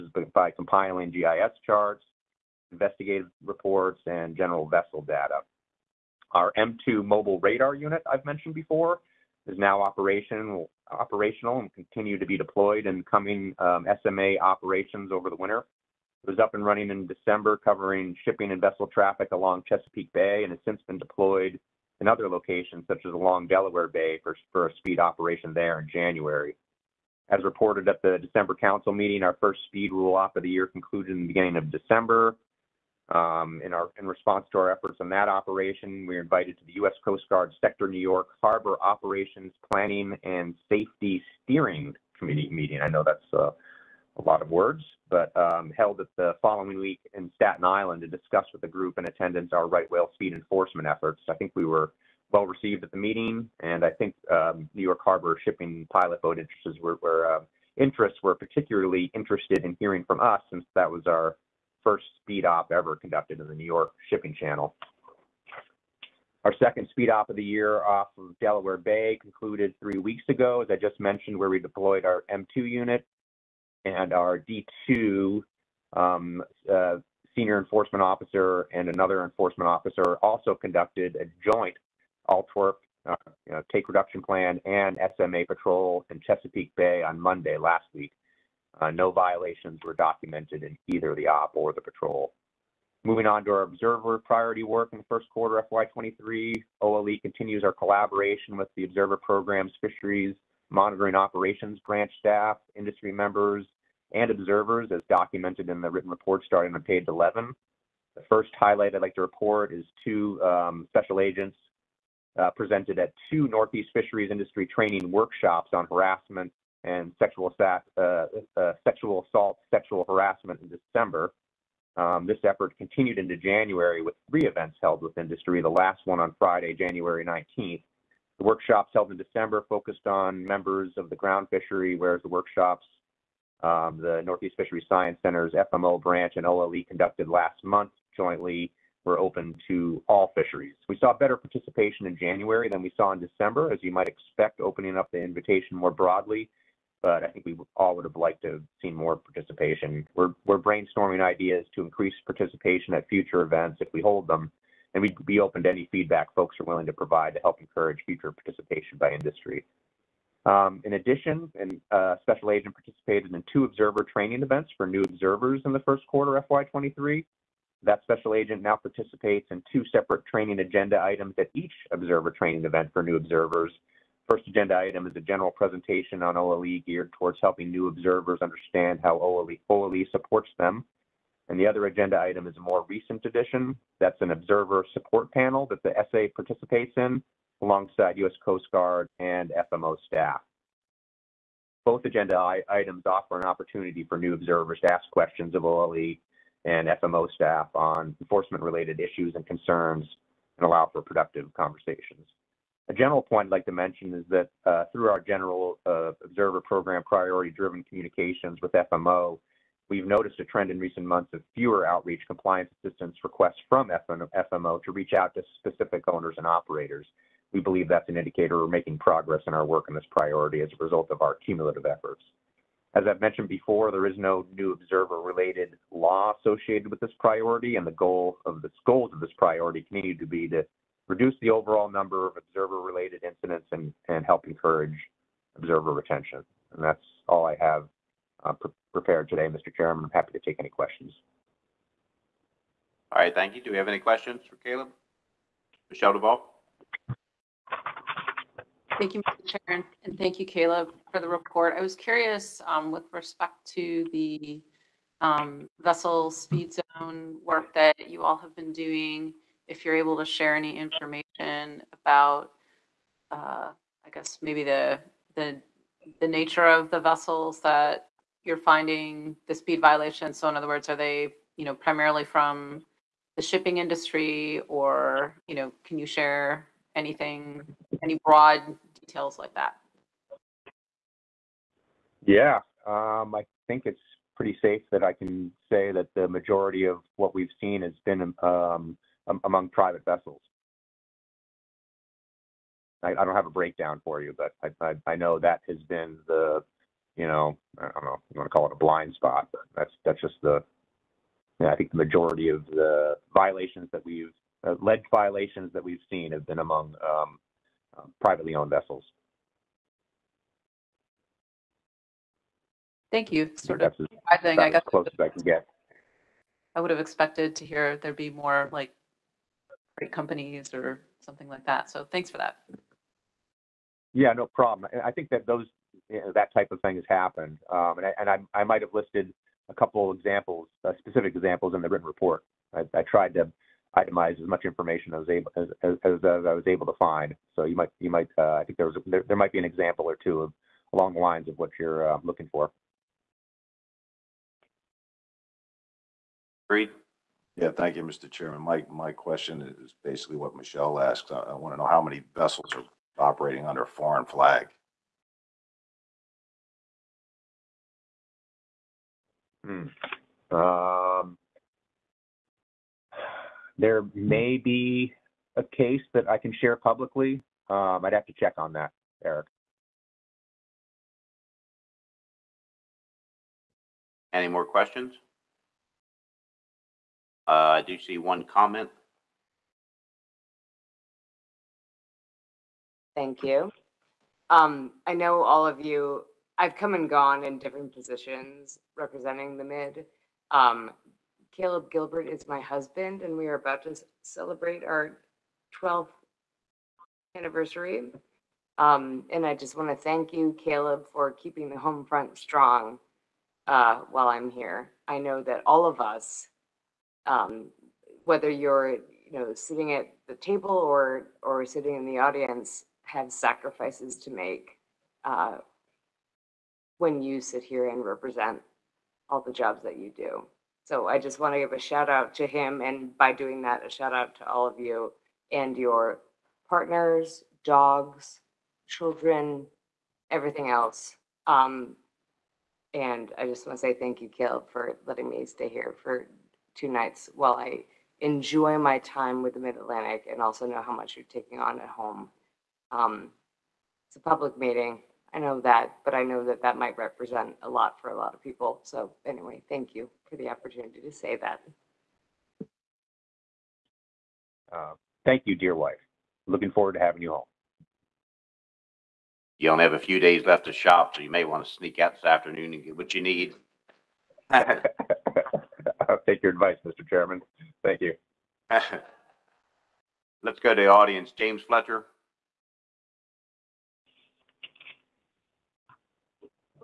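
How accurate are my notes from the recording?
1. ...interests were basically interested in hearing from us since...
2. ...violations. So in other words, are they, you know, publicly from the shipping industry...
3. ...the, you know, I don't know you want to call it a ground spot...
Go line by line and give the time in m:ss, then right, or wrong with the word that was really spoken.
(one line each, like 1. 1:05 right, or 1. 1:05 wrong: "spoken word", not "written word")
1. 0:57 wrong: "particularly", not "basically"
2. 4:29 wrong: "primarily", not "publicly"
3. 4:56 wrong: "blind", not "ground".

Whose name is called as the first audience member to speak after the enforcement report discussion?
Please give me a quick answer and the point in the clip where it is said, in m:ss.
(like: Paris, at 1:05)
James Fletcher, at 7:51.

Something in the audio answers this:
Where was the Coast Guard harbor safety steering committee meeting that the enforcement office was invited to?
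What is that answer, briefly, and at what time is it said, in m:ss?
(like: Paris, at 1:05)
Staten Island, at 0:47.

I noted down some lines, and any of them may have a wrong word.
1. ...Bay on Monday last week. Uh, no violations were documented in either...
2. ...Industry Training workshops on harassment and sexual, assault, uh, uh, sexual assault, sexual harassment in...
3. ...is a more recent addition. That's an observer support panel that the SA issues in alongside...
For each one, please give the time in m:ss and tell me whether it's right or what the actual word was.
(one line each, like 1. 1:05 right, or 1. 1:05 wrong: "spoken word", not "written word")
1. 1:26 right
2. 1:54 right
3. 3:02 wrong: "participates", not "issues".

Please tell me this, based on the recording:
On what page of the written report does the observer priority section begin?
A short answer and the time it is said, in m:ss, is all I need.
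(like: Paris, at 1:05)
11, at 1:46.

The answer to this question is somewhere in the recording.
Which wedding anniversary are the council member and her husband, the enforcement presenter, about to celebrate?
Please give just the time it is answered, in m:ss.
6:35.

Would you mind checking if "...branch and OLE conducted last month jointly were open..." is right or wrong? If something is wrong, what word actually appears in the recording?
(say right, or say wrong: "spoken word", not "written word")
right.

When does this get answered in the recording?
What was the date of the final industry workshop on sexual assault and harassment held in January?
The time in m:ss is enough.
2:06.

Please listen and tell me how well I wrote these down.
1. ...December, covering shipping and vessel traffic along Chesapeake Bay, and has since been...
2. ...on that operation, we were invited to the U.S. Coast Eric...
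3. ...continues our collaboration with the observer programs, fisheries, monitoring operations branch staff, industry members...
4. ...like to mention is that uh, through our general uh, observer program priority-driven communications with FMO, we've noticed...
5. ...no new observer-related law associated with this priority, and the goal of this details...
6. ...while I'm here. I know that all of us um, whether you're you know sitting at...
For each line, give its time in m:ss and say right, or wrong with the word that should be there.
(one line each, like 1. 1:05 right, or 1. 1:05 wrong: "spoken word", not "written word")
1. 0:17 right
2. 0:34 wrong: "Guard", not "Eric"
3. 1:37 right
4. 3:23 right
5. 3:44 wrong: "goals", not "details"
6. 6:44 right.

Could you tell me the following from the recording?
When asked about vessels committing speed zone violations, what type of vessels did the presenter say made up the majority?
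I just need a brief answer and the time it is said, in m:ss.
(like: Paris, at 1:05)
private vessels, at 4:49.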